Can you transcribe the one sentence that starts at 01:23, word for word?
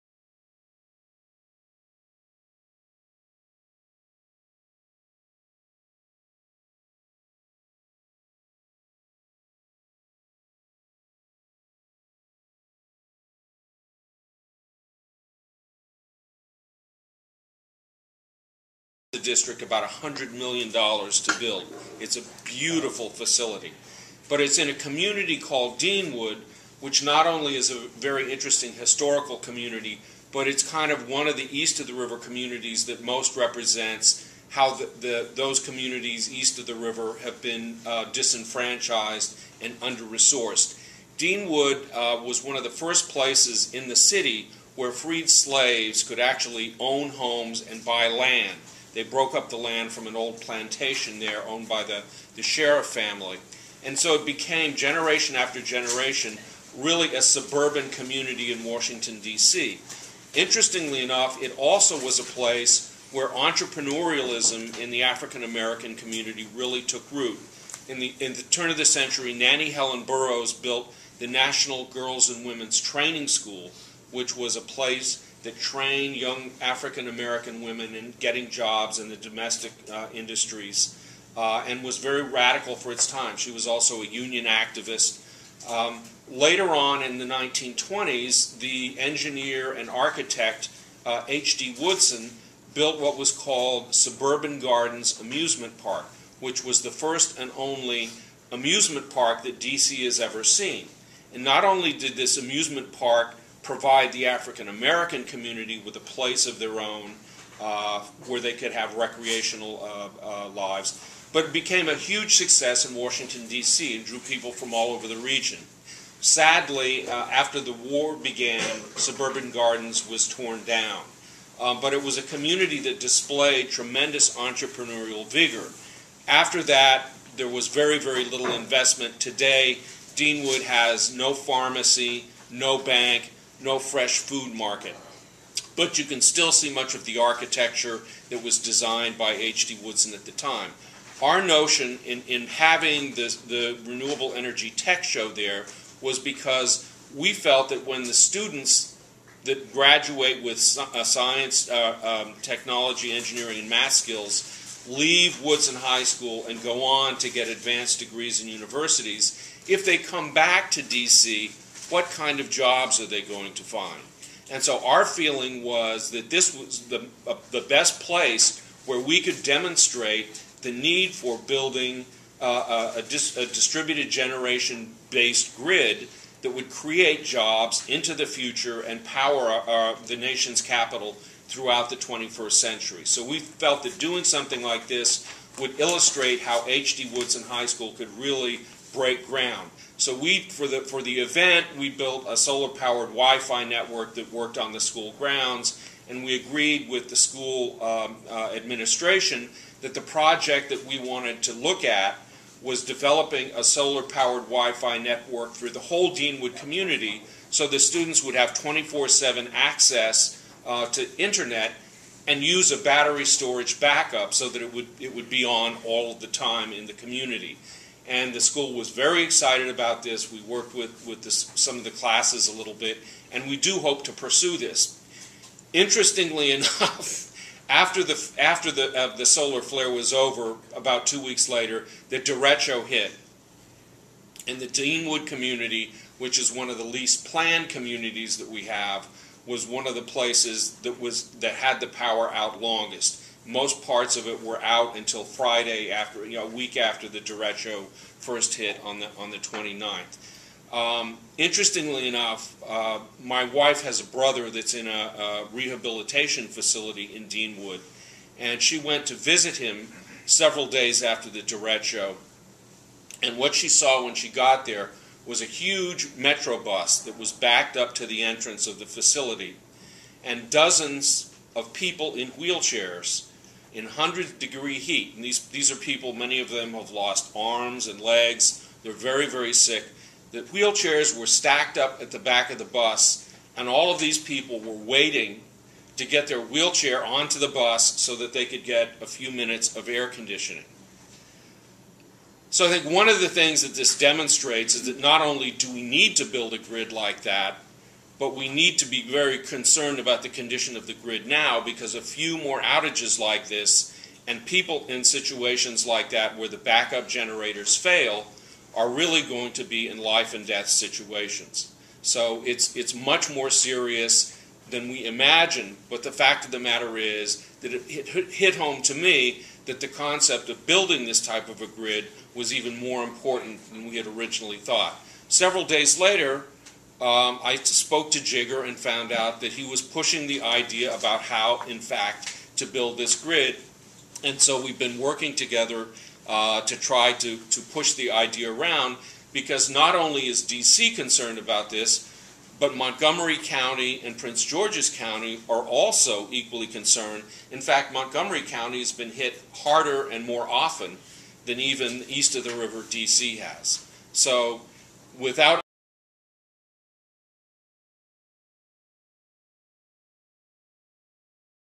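She was also a union activist.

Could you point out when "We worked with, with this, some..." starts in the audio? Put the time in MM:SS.
03:40.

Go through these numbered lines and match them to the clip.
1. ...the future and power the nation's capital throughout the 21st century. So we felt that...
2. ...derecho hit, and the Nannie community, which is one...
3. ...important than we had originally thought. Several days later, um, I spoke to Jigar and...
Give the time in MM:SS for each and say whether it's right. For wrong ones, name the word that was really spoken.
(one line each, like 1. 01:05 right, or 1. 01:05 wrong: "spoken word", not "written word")
1. 02:58 right
2. 03:52 wrong: "Deanwood", not "Nannie"
3. 05:23 right.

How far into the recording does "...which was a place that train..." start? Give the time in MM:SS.
01:14.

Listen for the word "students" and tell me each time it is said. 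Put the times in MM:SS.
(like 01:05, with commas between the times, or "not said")
02:28, 03:27.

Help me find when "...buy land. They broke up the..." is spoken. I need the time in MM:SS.
00:47.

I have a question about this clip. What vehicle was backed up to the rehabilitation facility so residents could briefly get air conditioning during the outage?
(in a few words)
metro bus.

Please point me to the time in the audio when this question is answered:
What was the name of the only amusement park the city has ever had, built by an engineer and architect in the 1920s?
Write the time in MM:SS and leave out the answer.
01:33.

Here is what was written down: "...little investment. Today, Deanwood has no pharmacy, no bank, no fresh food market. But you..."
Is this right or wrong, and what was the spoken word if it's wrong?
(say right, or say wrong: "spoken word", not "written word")
right.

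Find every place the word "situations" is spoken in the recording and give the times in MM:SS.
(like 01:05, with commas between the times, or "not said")
05:05, 05:10.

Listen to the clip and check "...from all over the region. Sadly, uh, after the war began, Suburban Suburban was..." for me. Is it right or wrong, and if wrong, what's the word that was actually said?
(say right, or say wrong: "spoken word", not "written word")
wrong: "Gardens", not "Suburban".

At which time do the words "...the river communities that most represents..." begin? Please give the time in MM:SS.
00:31.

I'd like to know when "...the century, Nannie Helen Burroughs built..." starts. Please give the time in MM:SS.
01:08.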